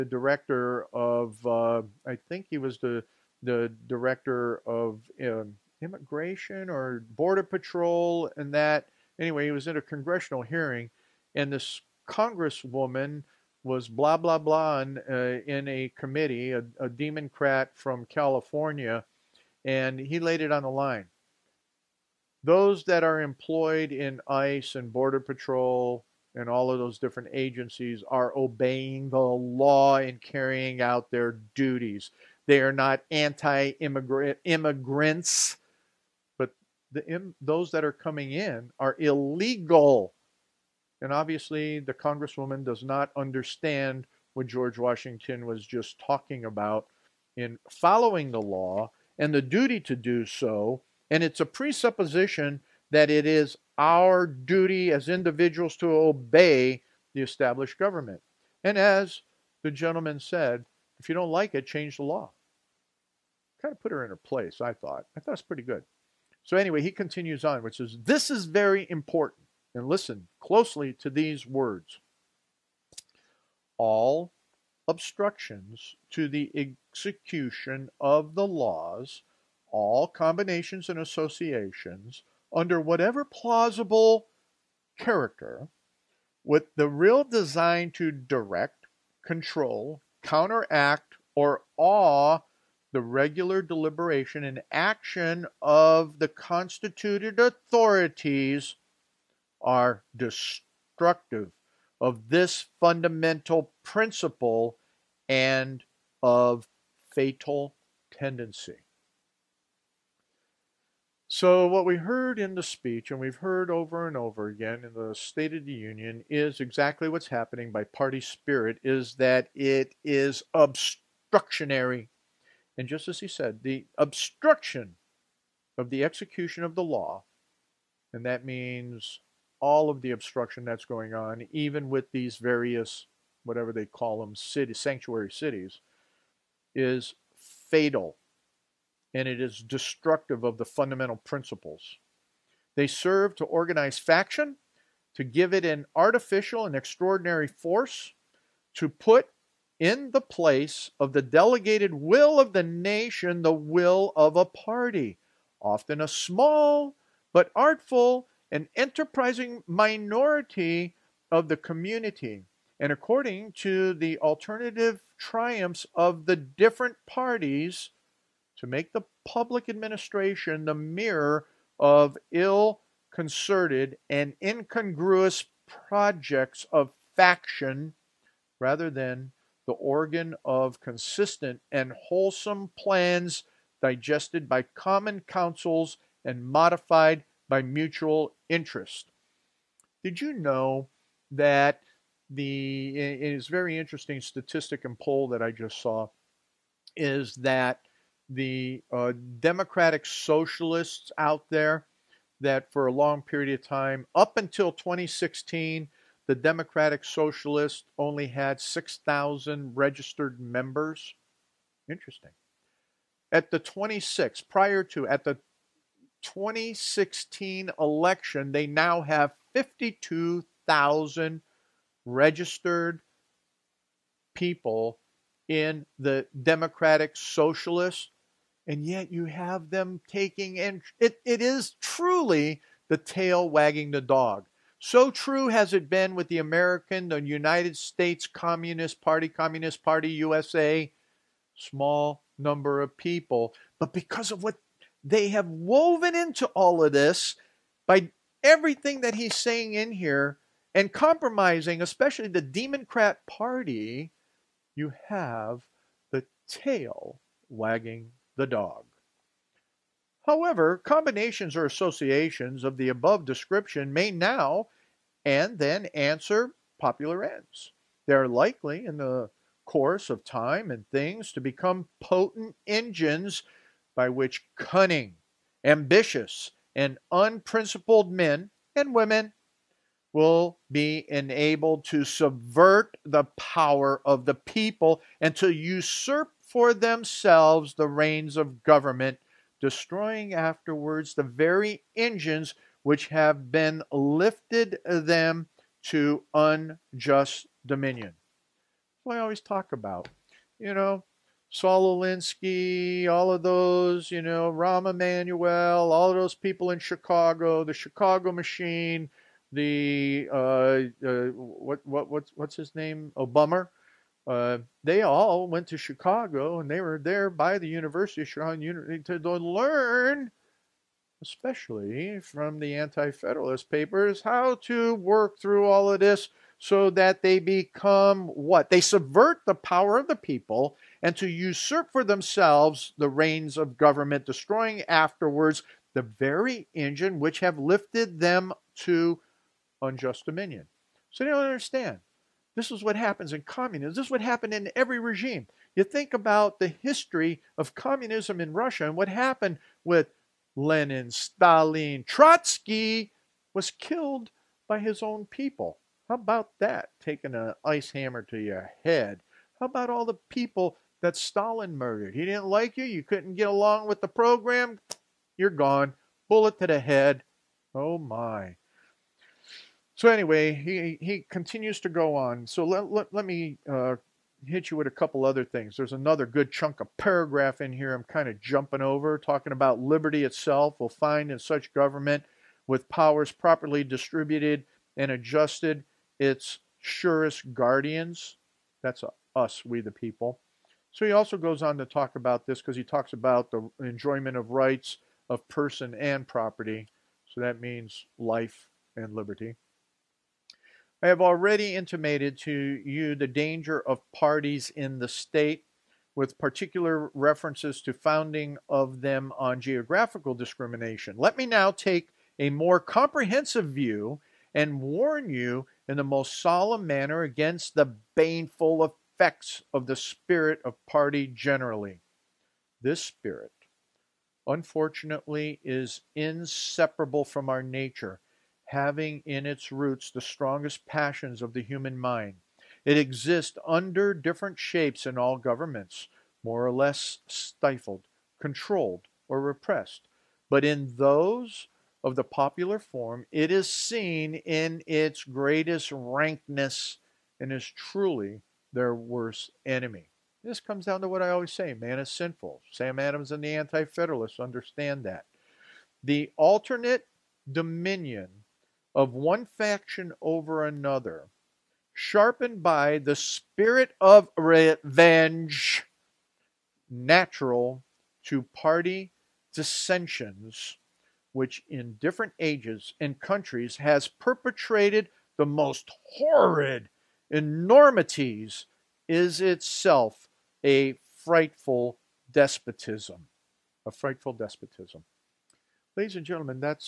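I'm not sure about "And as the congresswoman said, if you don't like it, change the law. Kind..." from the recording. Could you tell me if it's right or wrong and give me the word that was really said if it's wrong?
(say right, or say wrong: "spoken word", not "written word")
wrong: "gentleman", not "congresswoman".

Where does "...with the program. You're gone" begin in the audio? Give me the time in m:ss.
6:03.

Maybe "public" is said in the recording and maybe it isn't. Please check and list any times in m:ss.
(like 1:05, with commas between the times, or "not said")
2:49.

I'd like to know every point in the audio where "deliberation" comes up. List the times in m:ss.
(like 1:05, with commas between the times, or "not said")
1:33.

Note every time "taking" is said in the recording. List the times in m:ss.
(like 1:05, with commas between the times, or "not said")
3:50, 5:56.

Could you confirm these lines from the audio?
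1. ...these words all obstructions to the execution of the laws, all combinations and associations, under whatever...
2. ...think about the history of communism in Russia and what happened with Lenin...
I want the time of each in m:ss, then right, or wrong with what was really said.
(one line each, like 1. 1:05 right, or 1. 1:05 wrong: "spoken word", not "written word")
1. 1:11 right
2. 5:45 right.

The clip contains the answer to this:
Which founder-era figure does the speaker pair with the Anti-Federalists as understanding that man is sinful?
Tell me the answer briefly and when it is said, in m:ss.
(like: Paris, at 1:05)
Sam Adams, at 7:32.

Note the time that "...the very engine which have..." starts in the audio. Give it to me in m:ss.
5:35.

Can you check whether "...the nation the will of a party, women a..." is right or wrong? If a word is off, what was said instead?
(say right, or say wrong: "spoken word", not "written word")
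wrong: "often", not "women".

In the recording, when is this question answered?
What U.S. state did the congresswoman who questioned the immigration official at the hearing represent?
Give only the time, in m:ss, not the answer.
0:18.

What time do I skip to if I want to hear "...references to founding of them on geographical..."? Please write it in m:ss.
6:47.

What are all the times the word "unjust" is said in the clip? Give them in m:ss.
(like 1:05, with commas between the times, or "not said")
4:56, 5:39.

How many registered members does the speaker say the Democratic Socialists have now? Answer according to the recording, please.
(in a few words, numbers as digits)
52,000.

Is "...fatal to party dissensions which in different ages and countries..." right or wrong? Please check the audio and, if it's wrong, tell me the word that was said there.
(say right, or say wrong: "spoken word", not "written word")
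wrong: "natural", not "fatal".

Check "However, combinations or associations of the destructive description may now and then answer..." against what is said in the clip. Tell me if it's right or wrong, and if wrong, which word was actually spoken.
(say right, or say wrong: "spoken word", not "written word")
wrong: "above", not "destructive".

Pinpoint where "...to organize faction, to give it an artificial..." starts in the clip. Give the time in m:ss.
2:23.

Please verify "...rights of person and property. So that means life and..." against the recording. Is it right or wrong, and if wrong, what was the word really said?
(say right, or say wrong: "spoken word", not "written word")
right.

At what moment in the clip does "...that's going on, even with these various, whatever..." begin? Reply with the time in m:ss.
2:10.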